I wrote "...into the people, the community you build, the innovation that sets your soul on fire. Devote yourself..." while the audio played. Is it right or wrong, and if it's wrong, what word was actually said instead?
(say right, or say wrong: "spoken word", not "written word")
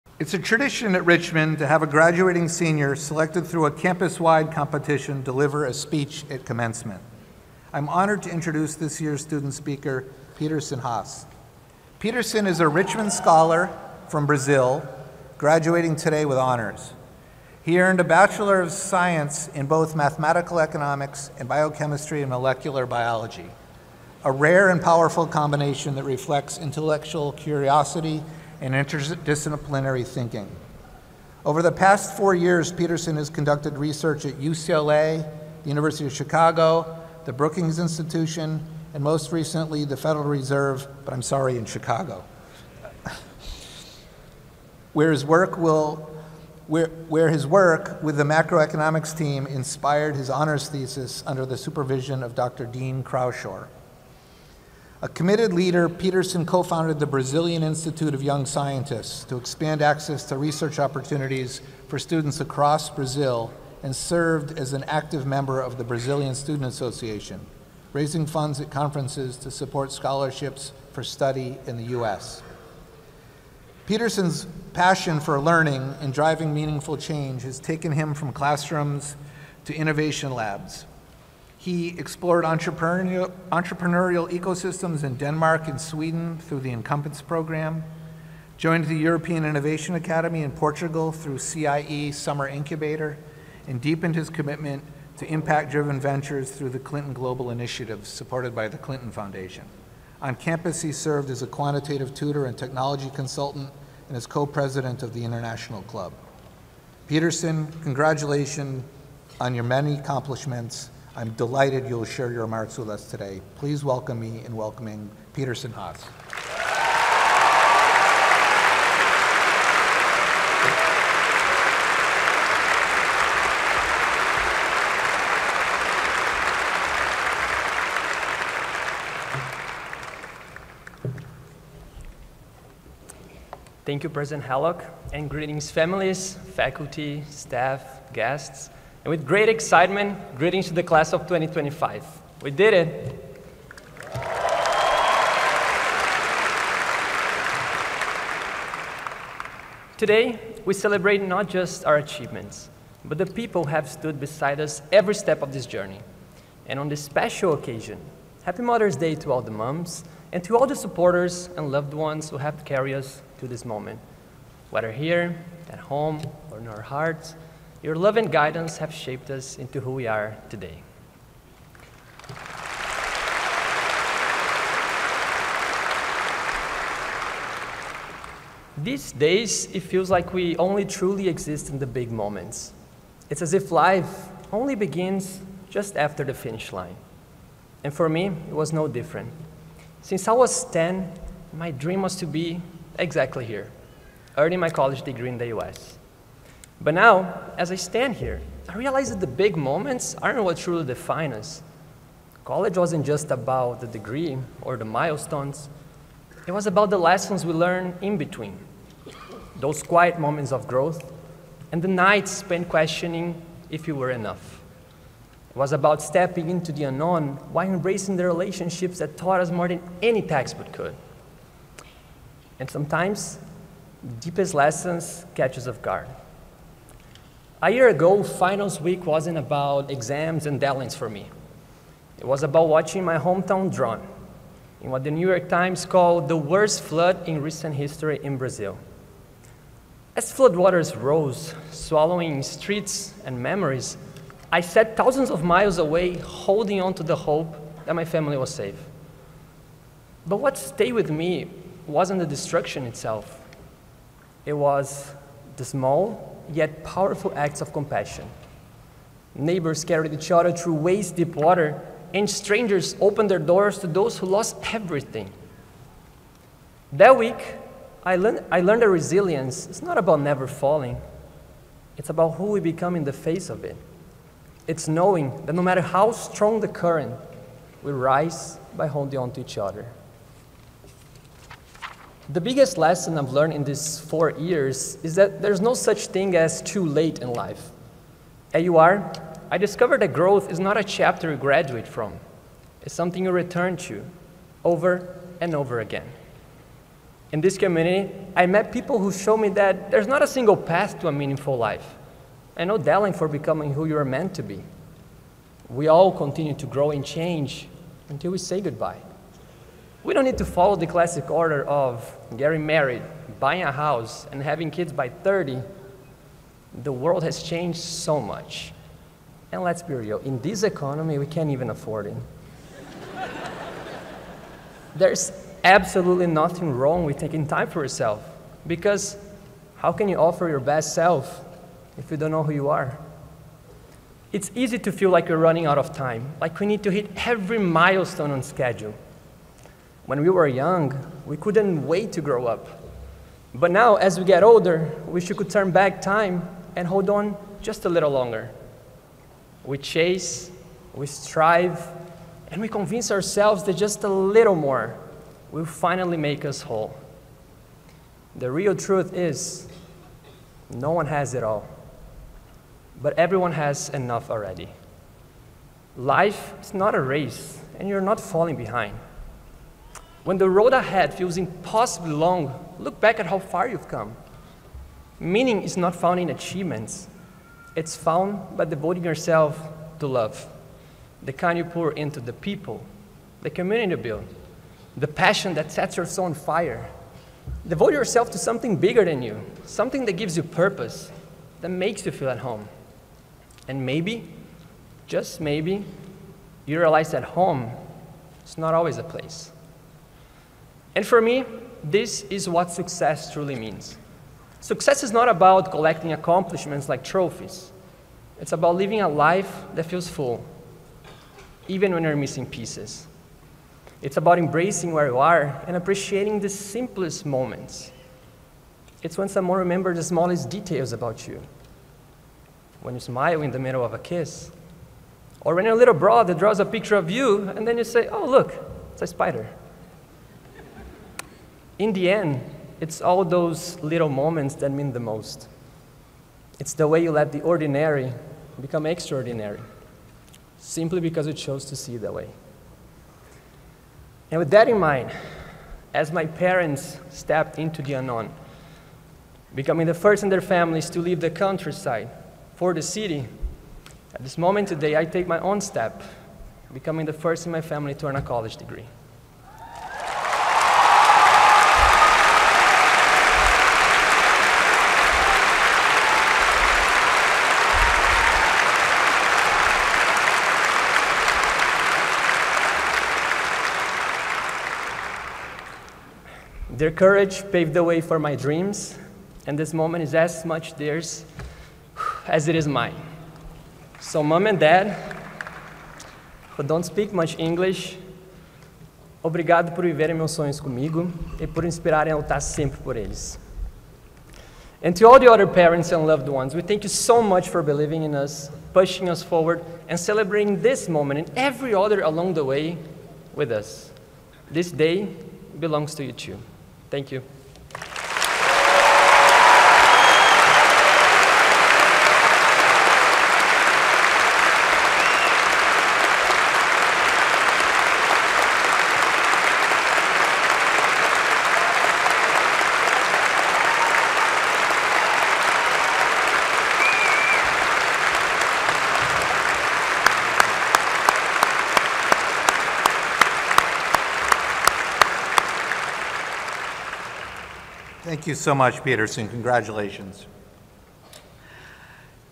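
wrong: "passion", not "innovation".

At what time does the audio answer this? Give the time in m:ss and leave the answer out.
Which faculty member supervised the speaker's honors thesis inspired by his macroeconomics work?
0:52.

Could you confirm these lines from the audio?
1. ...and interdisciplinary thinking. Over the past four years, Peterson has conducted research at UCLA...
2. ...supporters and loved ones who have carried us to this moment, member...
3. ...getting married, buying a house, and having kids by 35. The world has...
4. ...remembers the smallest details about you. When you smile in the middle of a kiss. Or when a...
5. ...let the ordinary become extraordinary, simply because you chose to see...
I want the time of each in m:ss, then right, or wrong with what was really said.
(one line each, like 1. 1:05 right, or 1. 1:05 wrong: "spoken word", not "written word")
1. 0:28 right
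2. 2:40 wrong: "whether", not "member"
3. 5:12 wrong: "30", not "35"
4. 6:59 right
5. 7:17 right.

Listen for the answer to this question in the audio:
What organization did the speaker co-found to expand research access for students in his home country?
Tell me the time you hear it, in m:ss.
0:57.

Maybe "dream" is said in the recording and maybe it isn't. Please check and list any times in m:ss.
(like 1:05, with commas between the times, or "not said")
3:11, 7:58.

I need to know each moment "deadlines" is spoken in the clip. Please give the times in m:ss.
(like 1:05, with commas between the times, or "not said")
3:50, 5:02.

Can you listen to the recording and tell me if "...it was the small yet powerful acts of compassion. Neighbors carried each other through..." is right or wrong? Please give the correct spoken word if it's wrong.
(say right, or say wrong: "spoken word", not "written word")
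right.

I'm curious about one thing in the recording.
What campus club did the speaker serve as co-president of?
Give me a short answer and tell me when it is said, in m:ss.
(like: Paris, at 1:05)
International Club, at 1:45.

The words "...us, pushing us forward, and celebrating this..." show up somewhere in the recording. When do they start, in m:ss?
8:18.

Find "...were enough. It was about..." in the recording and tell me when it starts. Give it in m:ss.
3:33.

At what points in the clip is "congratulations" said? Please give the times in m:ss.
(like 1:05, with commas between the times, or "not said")
1:47, 8:59.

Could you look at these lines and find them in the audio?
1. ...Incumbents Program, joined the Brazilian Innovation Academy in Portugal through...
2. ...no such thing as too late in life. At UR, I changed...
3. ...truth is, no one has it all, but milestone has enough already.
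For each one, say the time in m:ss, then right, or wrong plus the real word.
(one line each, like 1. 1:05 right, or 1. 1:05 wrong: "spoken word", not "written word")
1. 1:26 wrong: "European", not "Brazilian"
2. 4:45 wrong: "discovered", not "changed"
3. 5:58 wrong: "everyone", not "milestone".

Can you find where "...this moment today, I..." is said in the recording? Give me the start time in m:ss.
7:34.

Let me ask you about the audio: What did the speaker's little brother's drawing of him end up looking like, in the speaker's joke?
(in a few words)
a spider.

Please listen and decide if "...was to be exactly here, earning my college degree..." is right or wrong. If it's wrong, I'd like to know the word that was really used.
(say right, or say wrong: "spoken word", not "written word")
right.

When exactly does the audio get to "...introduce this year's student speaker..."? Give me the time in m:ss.
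0:08.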